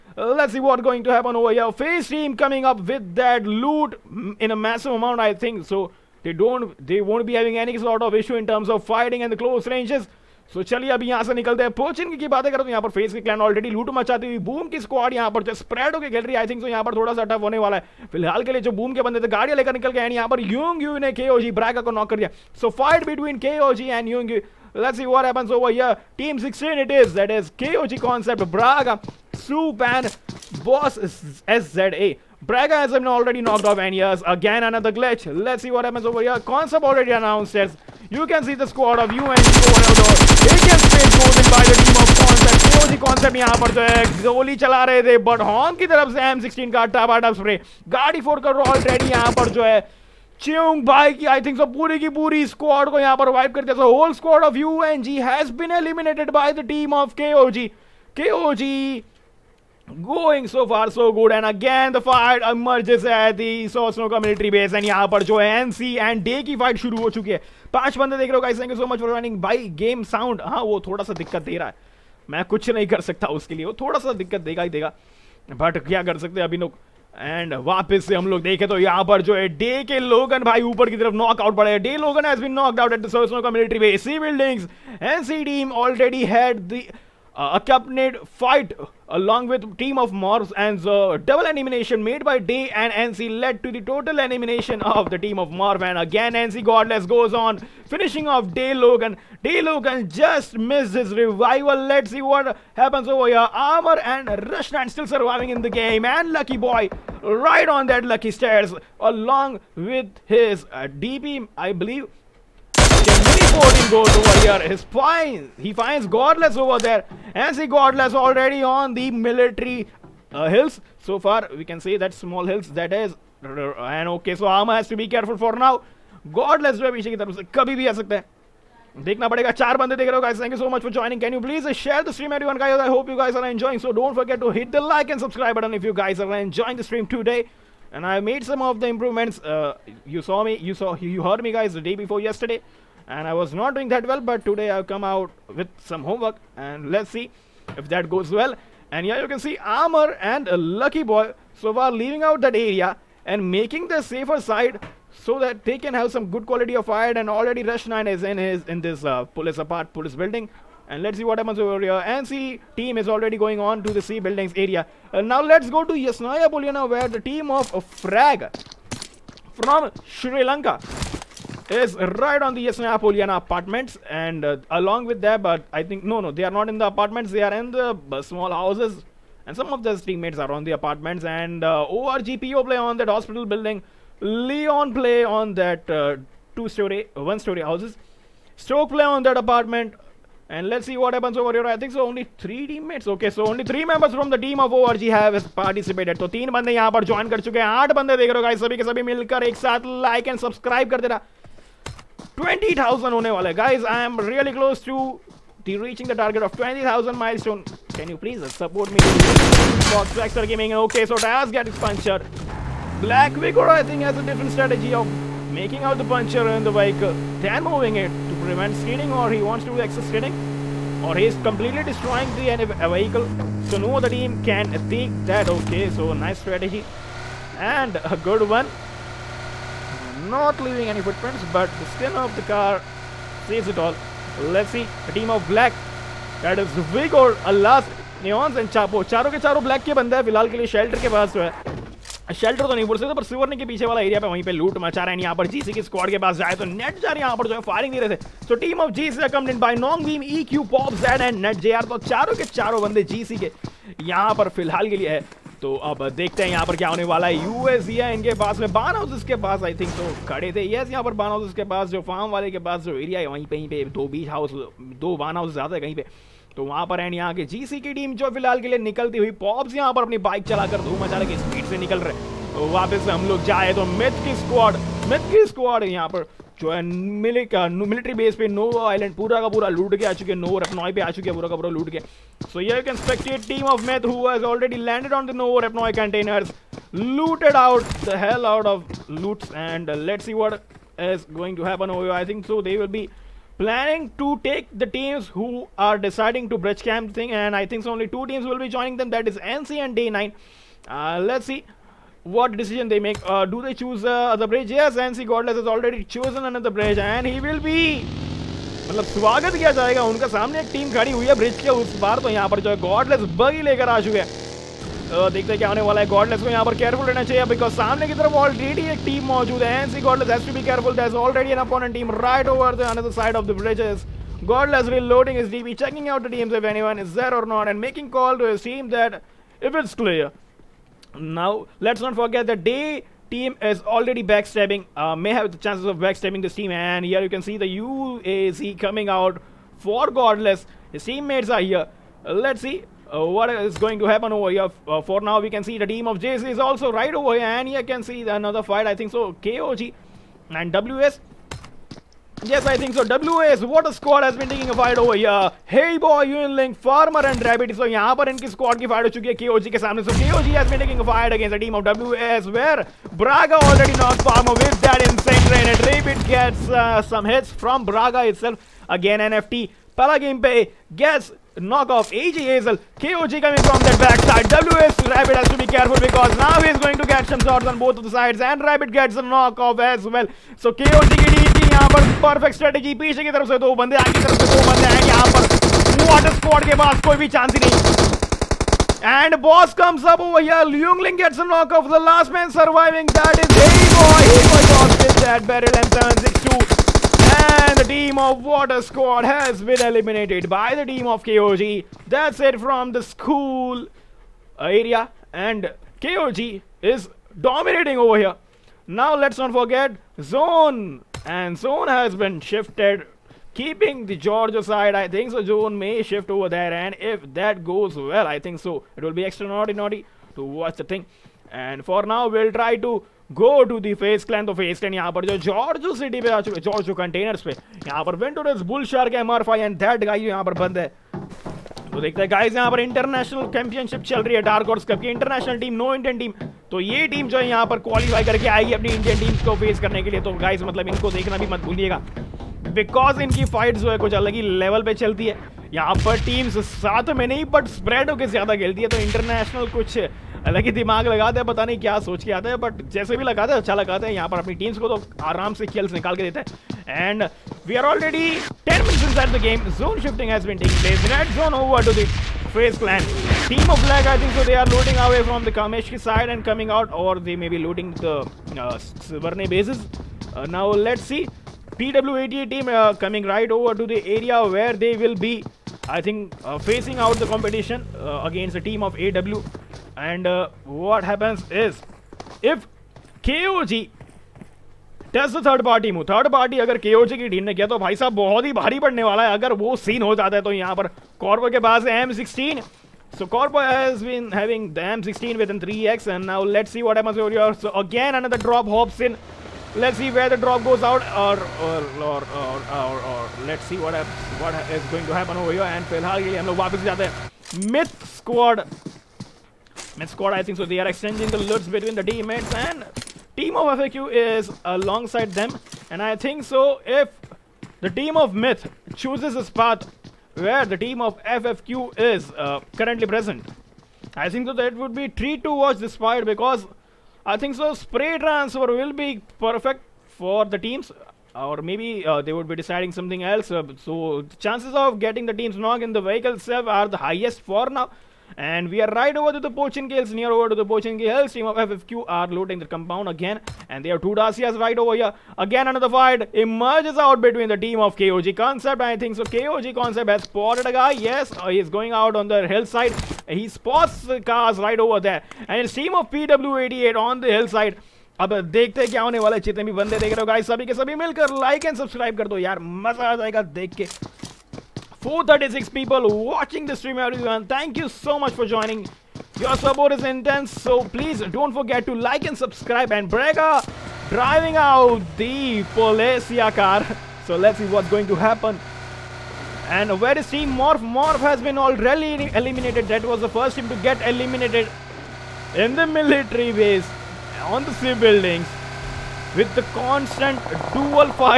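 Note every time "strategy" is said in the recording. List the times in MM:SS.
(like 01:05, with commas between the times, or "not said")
03:34, 03:46, 06:22.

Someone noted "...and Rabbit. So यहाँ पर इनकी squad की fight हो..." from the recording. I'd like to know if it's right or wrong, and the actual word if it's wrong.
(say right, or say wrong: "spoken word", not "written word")
right.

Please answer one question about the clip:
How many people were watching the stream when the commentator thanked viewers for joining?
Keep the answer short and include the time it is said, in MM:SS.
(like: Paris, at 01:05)
436, at 09:25.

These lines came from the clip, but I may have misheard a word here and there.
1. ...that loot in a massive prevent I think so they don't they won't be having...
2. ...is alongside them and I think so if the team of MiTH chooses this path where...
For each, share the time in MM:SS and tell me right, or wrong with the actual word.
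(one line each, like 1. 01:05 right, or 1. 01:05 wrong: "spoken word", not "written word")
1. 00:03 wrong: "amount", not "prevent"
2. 08:34 right.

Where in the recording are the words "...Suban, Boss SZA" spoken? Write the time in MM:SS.
00:29.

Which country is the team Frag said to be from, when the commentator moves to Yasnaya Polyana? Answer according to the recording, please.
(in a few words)
Sri Lanka.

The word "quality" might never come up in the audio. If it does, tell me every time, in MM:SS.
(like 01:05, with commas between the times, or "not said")
02:36.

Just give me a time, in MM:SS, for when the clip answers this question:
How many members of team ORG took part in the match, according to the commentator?
03:13.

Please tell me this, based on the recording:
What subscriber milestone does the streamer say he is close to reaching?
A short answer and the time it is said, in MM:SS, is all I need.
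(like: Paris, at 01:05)
20,000, at 03:26.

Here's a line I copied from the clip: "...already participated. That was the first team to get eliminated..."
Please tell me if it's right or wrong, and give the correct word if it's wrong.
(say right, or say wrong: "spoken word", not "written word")
wrong: "eliminated", not "participated".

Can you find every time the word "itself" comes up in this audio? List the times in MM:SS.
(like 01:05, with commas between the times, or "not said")
06:08, 08:56.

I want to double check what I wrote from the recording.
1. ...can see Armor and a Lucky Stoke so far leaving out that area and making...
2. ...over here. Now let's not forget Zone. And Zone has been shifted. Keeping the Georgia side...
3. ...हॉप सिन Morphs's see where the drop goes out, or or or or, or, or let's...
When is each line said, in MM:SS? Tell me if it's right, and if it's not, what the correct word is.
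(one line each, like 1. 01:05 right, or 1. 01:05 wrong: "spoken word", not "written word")
1. 02:29 wrong: "Boy", not "Stoke"
2. 06:47 right
3. 08:18 wrong: "Let", not "Morphs".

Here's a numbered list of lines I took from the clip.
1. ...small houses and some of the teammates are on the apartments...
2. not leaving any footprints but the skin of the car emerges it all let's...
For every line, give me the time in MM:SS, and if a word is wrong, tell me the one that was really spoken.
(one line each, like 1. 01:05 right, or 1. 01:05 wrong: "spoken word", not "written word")
1. 02:58 right
2. 03:50 wrong: "saves", not "emerges".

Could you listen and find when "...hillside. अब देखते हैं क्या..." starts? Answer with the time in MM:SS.
09:17.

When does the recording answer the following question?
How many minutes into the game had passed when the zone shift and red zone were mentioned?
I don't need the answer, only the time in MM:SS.
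07:38.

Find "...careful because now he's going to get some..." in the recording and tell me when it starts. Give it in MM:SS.
06:15.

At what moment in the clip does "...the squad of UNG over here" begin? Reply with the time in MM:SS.
00:38.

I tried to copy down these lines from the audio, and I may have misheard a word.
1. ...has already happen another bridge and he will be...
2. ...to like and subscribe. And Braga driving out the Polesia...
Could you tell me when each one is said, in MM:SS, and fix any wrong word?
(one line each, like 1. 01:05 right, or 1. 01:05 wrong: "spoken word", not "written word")
1. 05:05 wrong: "chosen", not "happen"
2. 09:31 right.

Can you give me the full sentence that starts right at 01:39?
Day Logan just missed his revival.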